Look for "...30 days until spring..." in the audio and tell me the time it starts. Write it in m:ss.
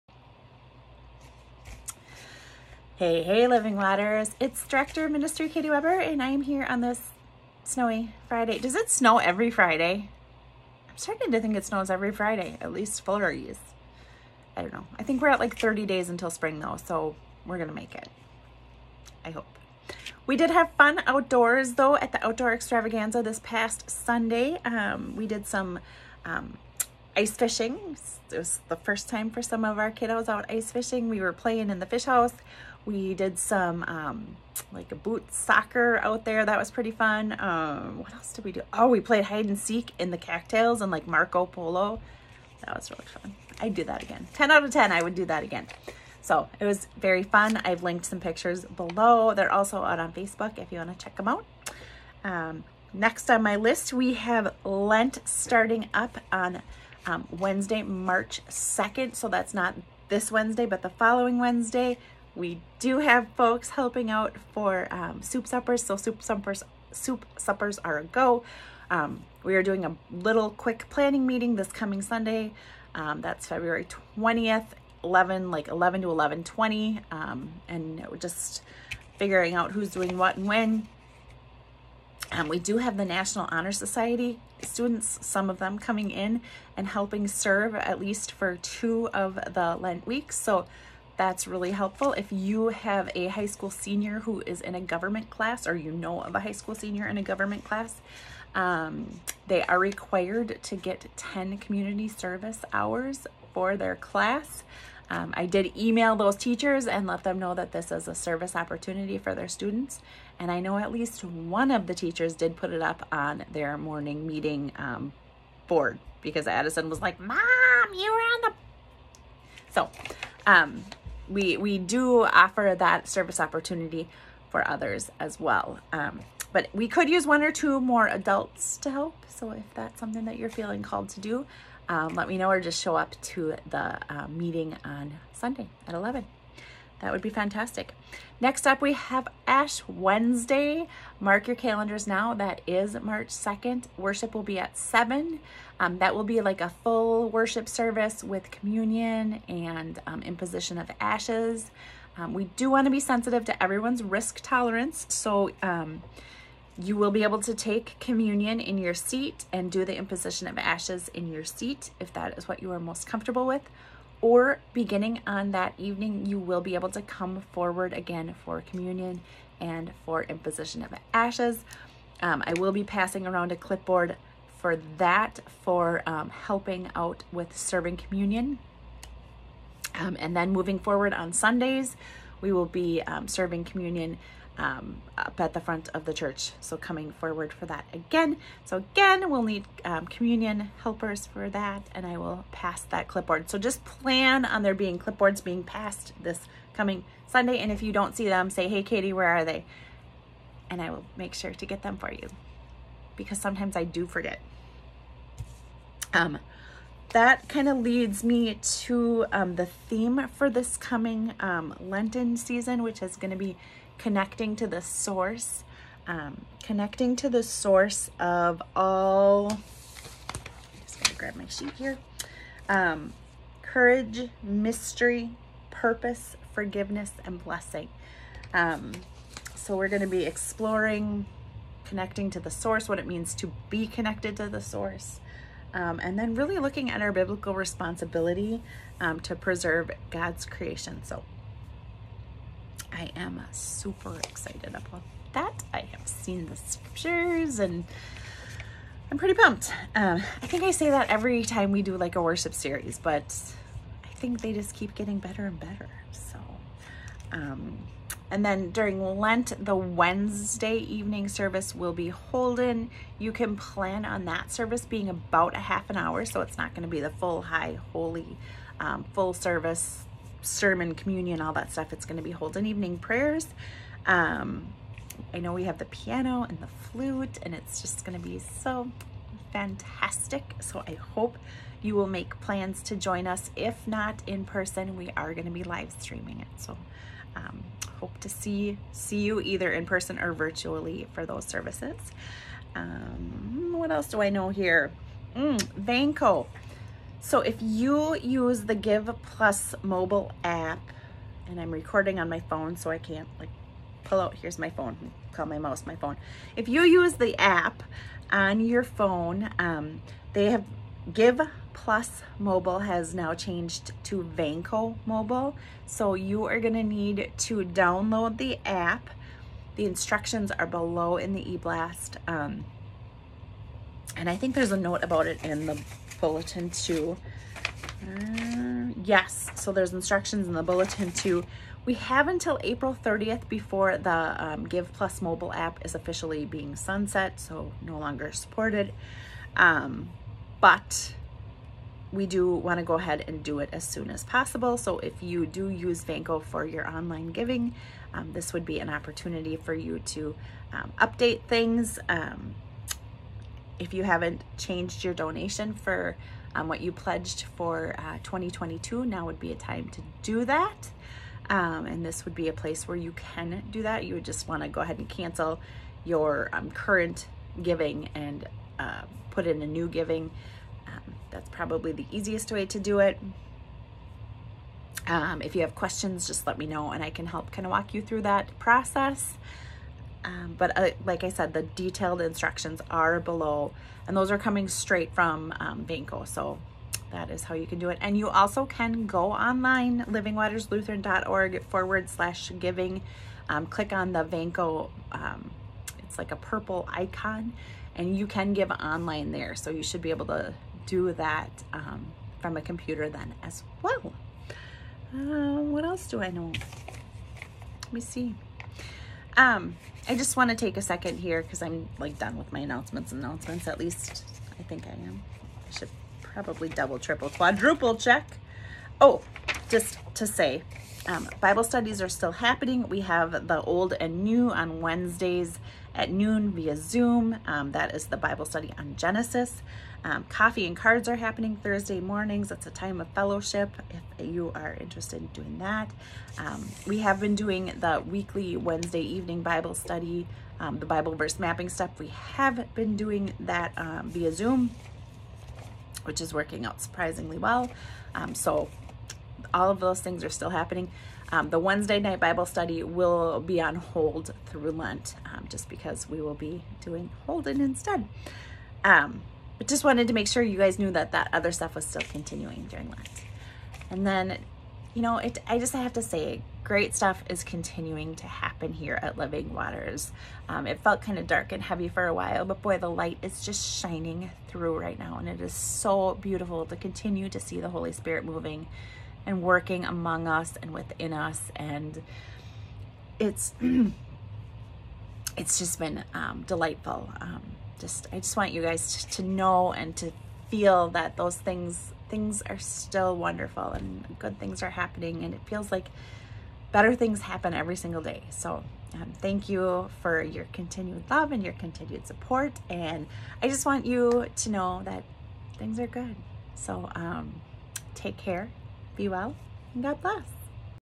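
0:15.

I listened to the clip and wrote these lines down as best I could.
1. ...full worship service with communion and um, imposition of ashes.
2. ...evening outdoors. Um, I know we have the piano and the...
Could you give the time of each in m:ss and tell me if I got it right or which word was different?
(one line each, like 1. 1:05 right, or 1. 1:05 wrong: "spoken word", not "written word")
1. 2:26 right
2. 4:32 wrong: "prayers", not "outdoors".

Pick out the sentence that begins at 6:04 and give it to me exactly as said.
You would just want to go ahead and cancel your um, current giving and uh, put in a new giving.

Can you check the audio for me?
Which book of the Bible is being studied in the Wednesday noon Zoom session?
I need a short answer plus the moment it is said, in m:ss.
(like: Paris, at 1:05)
Genesis, at 7:08.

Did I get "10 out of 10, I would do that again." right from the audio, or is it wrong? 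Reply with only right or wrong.
right.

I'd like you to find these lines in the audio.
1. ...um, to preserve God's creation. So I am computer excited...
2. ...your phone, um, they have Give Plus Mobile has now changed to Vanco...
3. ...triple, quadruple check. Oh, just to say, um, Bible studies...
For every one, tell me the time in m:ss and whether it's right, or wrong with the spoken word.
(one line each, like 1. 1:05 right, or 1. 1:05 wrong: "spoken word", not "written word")
1. 3:58 wrong: "super", not "computer"
2. 5:08 right
3. 6:56 right.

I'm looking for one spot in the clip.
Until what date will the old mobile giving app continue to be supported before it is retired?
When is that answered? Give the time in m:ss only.
5:32.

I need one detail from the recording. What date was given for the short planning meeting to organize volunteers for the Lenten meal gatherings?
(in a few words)
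February 20th.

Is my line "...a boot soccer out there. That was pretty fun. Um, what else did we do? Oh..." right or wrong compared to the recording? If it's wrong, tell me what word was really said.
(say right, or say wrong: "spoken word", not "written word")
right.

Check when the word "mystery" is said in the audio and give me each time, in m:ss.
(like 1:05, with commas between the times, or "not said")
3:44.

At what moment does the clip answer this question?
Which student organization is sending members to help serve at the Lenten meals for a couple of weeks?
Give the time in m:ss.
1:23.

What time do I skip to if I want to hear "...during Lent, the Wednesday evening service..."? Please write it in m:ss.
4:18.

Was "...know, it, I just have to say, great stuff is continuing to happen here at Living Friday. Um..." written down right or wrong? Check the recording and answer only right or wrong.
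wrong.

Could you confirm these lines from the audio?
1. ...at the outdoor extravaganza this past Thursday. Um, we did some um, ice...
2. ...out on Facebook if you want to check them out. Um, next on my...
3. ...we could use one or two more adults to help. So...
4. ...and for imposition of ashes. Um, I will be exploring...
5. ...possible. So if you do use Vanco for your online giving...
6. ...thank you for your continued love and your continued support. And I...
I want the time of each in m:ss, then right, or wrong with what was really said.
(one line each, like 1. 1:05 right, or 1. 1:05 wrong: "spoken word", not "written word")
1. 0:21 wrong: "Sunday", not "Thursday"
2. 0:49 right
3. 2:06 right
4. 2:49 wrong: "passing", not "exploring"
5. 5:44 right
6. 8:19 right.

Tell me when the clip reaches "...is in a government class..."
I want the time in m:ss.
1:34.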